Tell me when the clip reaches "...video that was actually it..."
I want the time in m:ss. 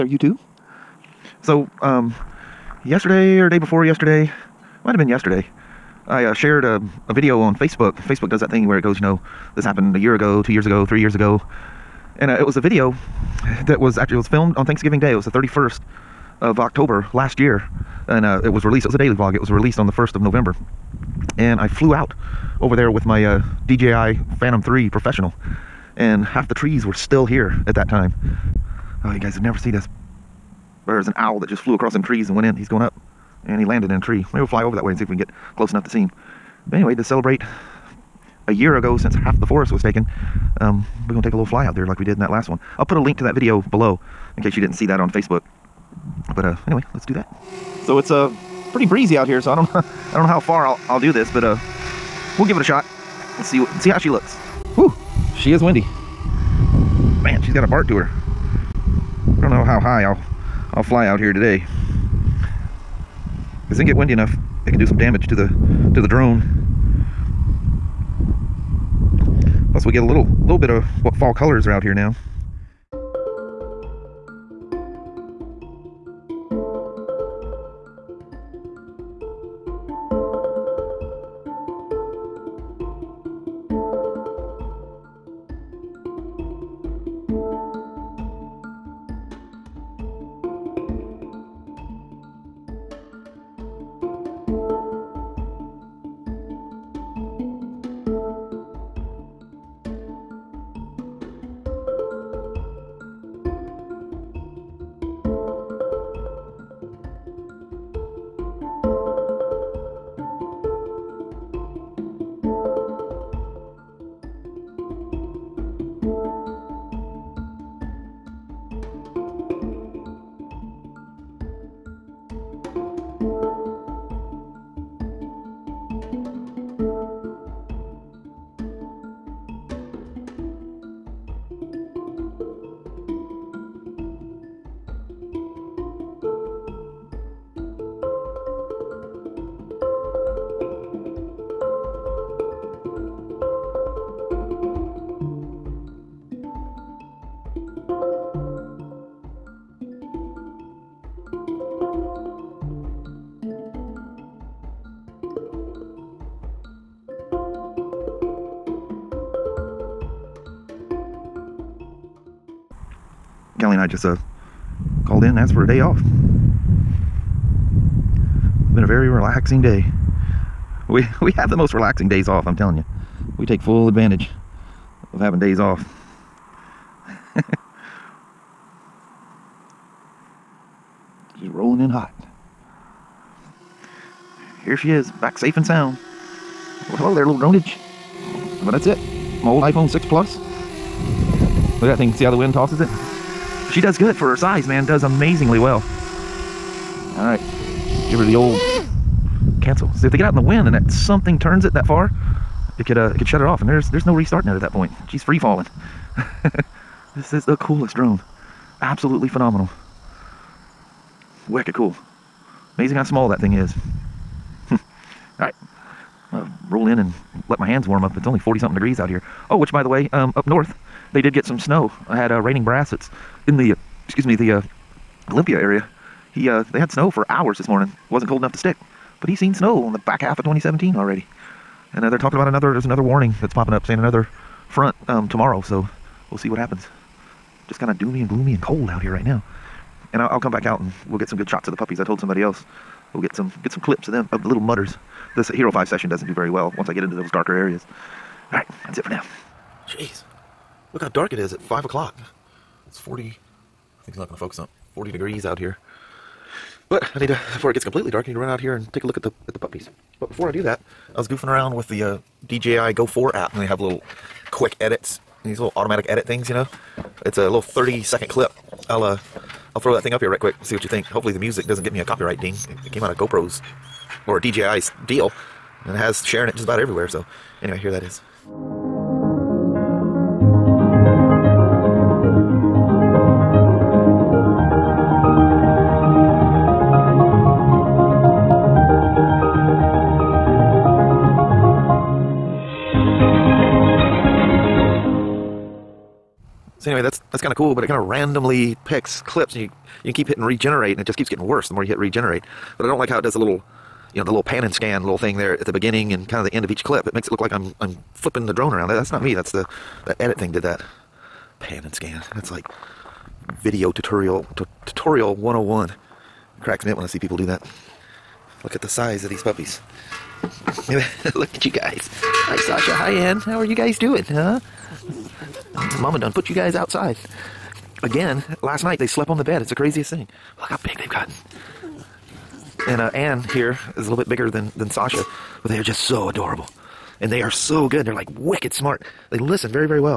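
0:12.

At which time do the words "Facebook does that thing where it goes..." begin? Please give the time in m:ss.
0:07.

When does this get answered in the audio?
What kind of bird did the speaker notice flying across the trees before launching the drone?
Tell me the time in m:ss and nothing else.
0:31.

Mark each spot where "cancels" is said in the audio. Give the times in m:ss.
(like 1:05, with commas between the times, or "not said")
3:19.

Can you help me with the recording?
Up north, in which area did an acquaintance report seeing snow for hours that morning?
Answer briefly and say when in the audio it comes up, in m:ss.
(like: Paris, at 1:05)
Olympia, at 3:45.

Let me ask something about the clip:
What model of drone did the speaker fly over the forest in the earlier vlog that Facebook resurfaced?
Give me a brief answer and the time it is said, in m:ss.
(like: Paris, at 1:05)
DJI Phantom 3 Professional, at 0:23.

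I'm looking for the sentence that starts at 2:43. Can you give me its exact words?
Kelly and I just uh, called in and asked for a day off.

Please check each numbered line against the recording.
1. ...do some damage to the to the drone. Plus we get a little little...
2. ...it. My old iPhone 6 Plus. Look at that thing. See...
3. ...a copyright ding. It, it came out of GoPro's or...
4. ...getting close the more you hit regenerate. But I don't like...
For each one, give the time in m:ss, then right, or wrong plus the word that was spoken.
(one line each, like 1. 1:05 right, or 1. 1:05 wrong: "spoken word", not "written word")
1. 1:04 right
2. 3:08 right
3. 4:31 right
4. 5:01 wrong: "worse", not "close".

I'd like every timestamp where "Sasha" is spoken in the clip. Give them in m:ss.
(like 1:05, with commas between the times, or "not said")
5:22, 5:34.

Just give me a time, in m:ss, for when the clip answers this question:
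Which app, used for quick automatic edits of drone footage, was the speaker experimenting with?
4:22.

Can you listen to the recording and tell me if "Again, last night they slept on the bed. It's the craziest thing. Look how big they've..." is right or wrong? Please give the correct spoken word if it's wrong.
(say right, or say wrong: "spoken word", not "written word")
right.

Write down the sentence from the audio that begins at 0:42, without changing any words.
I'll put a link to that video below in case you didn't see that on Facebook.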